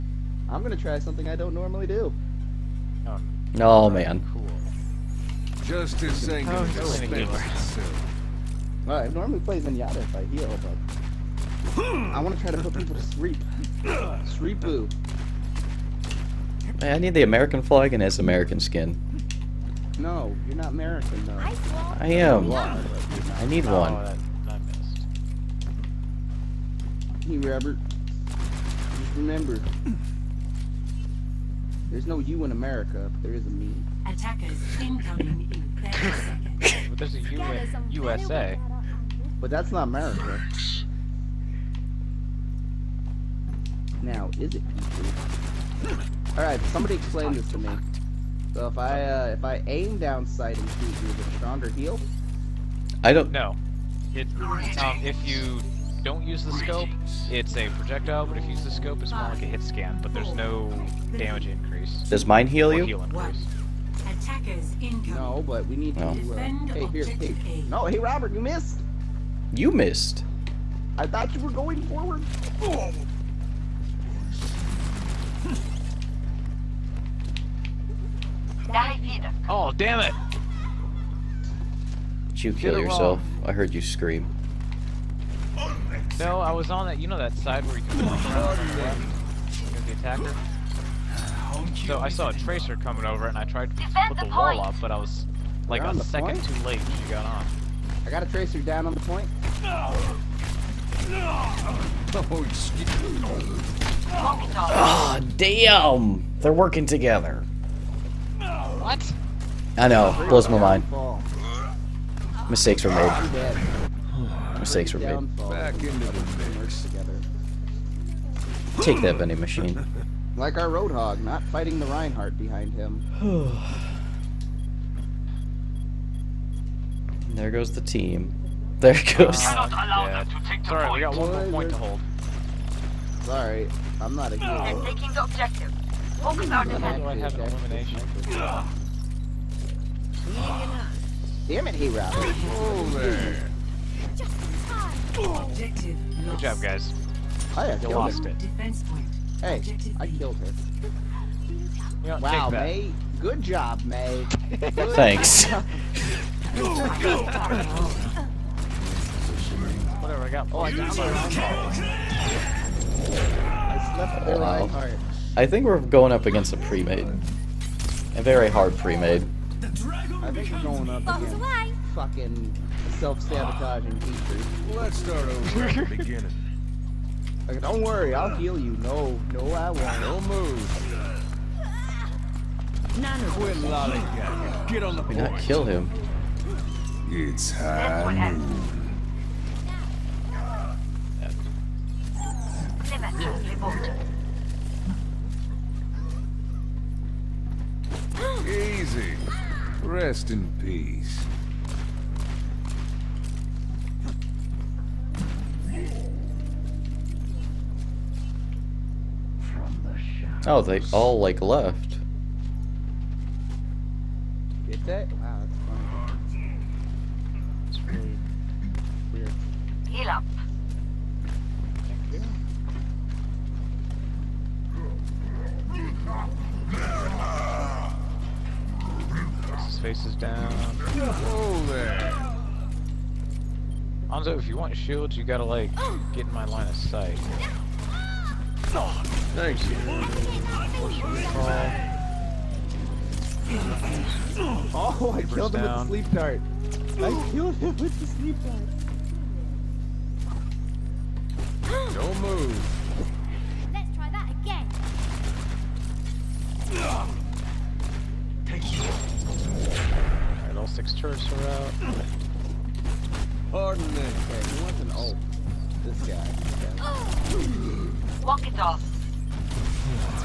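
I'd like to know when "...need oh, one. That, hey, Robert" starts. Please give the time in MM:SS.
00:23.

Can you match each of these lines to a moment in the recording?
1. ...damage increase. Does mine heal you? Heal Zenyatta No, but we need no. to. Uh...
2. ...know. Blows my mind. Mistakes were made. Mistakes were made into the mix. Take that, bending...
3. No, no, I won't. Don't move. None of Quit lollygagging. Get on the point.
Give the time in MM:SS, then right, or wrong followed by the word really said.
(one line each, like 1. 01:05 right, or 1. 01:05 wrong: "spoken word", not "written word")
1. 01:01 wrong: "Attackers", not "Zenyatta"
2. 01:49 right
3. 02:58 right.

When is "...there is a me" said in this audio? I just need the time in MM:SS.
00:33.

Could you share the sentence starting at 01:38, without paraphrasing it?
I got a tracer down on the point.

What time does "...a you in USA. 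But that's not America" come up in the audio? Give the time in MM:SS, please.
00:37.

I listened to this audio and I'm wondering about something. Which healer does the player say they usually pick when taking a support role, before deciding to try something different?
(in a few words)
Zenyatta.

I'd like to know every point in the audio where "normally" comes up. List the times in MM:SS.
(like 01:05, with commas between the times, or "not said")
00:01, 00:09.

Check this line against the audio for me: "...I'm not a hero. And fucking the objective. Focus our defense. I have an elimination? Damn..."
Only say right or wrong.
wrong.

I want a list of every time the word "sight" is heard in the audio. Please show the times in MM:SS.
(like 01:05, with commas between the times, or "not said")
00:50, 03:56.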